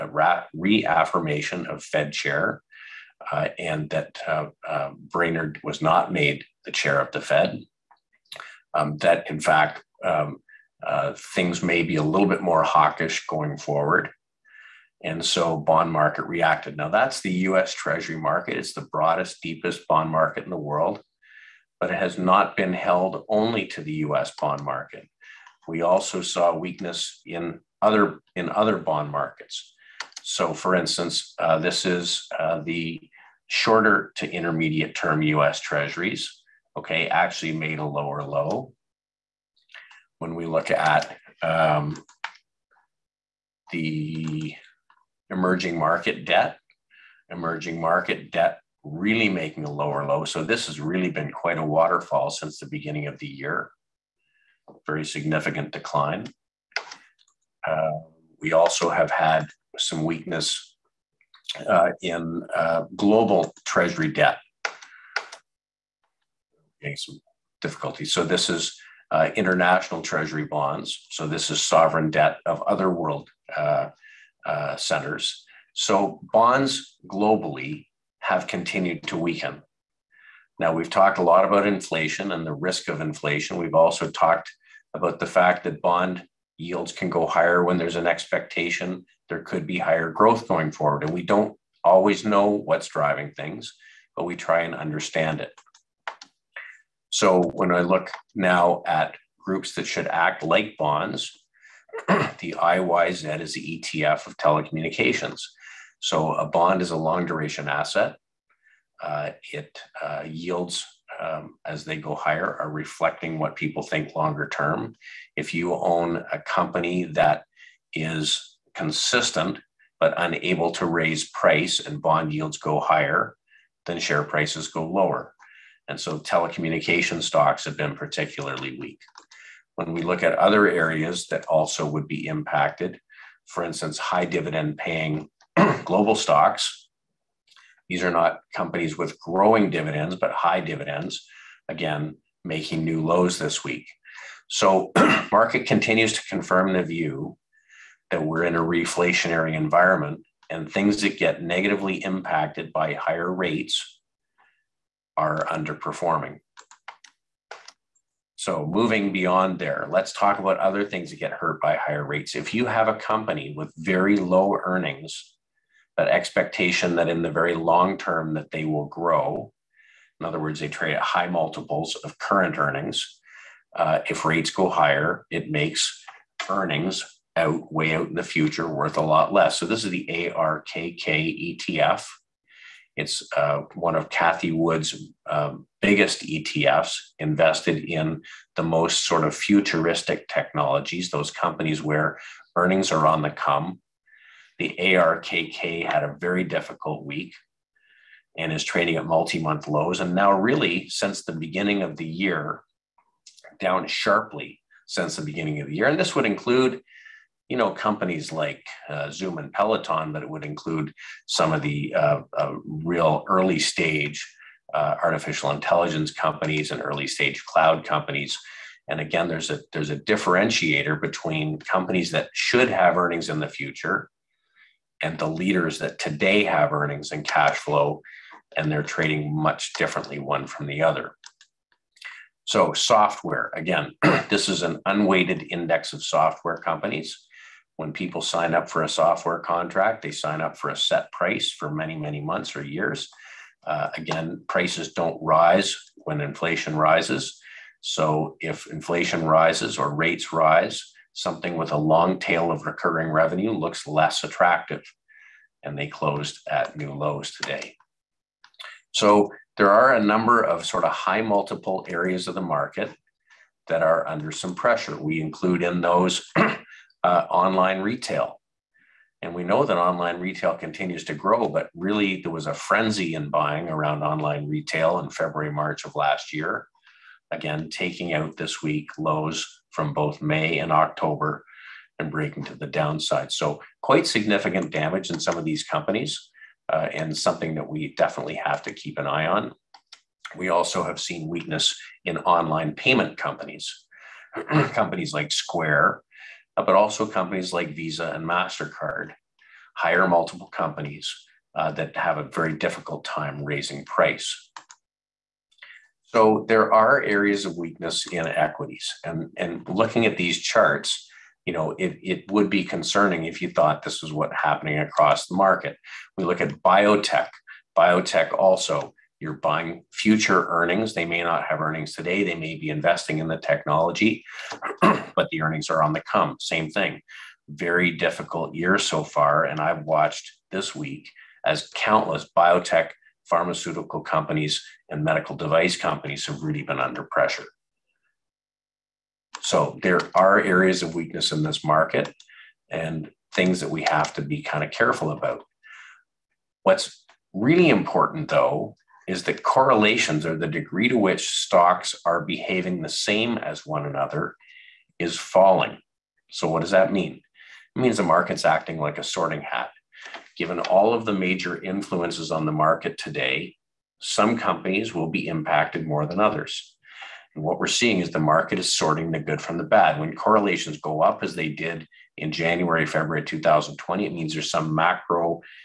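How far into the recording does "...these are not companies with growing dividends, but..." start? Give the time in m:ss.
2:17.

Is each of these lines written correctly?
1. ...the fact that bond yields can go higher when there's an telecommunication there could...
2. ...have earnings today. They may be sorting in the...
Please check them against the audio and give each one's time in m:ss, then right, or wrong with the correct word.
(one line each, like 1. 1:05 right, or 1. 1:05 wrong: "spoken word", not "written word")
1. 1:25 wrong: "expectation", not "telecommunication"
2. 5:21 wrong: "investing", not "sorting".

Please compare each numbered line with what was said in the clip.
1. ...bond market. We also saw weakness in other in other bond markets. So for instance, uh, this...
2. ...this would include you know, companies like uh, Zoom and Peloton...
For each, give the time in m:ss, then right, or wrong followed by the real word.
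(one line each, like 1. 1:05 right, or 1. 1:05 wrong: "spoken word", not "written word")
1. 0:24 right
2. 3:25 right.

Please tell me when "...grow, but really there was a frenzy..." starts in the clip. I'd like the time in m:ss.
4:31.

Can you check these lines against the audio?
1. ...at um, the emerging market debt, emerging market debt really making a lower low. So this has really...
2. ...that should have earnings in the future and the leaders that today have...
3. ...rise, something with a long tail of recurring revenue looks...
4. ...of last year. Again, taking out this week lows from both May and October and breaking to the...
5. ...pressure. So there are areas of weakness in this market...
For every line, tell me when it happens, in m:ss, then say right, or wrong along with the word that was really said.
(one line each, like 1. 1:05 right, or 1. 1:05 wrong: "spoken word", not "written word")
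1. 0:40 right
2. 3:42 right
3. 4:10 right
4. 4:35 right
5. 5:37 right.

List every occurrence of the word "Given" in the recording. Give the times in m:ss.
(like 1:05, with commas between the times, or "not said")
6:00.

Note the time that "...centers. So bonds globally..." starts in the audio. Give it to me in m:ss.
1:14.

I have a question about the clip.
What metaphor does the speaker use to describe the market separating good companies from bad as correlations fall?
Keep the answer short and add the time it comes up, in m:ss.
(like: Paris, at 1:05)
sorting hat, at 5:59.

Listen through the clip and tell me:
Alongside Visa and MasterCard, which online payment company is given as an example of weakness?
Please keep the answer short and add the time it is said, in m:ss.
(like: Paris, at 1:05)
Square, at 4:55.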